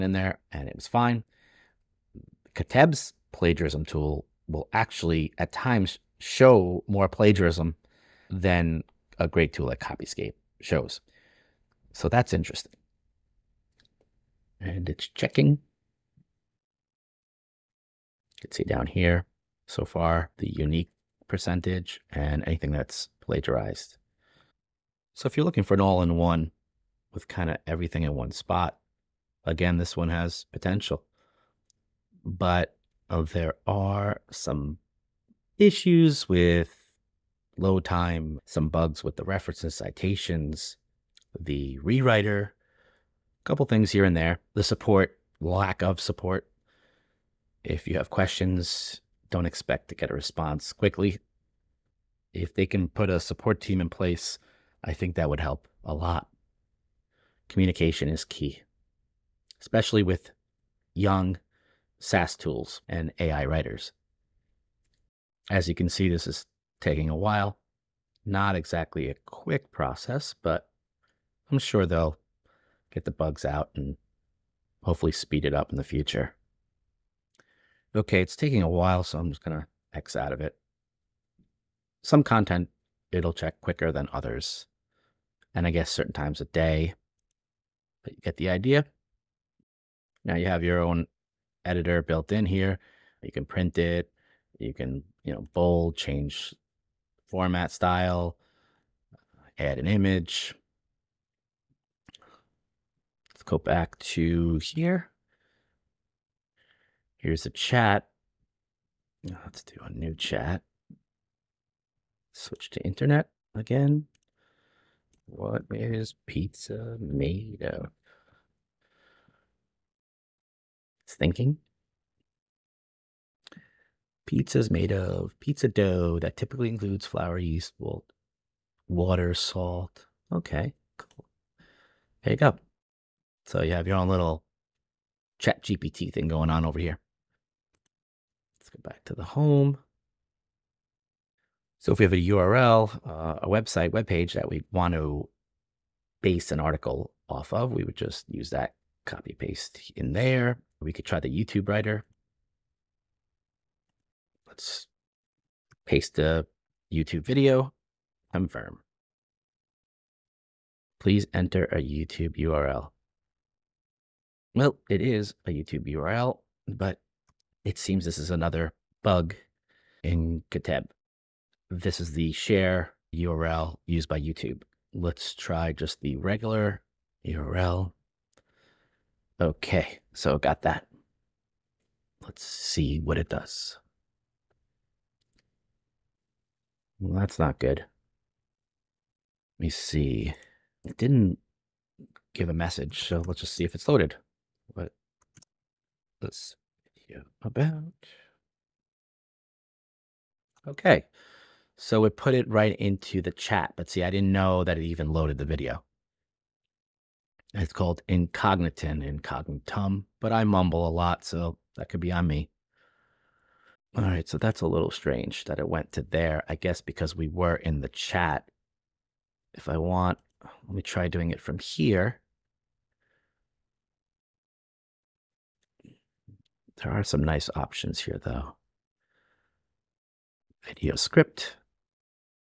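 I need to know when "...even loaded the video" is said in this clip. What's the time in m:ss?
3:24.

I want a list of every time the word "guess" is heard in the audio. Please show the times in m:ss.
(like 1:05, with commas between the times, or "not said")
1:25, 3:36.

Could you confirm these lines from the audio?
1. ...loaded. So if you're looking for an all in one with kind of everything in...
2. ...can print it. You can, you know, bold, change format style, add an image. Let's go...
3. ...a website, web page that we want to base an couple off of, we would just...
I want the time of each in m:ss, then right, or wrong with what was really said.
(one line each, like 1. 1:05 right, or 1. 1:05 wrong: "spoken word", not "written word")
1. 0:23 wrong: "plagiarized", not "loaded"
2. 1:33 right
3. 2:23 wrong: "article", not "couple".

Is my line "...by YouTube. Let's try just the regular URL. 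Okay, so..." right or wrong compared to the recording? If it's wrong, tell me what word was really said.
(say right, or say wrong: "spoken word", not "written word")
right.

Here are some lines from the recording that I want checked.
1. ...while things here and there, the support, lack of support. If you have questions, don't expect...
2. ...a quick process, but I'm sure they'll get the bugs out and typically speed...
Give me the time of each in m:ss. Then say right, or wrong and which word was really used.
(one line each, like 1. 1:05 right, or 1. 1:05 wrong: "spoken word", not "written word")
1. 0:43 wrong: "couple", not "while"
2. 1:09 wrong: "hopefully", not "typically".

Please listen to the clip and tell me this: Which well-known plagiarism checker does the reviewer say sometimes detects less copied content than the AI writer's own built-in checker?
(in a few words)
Copyscape.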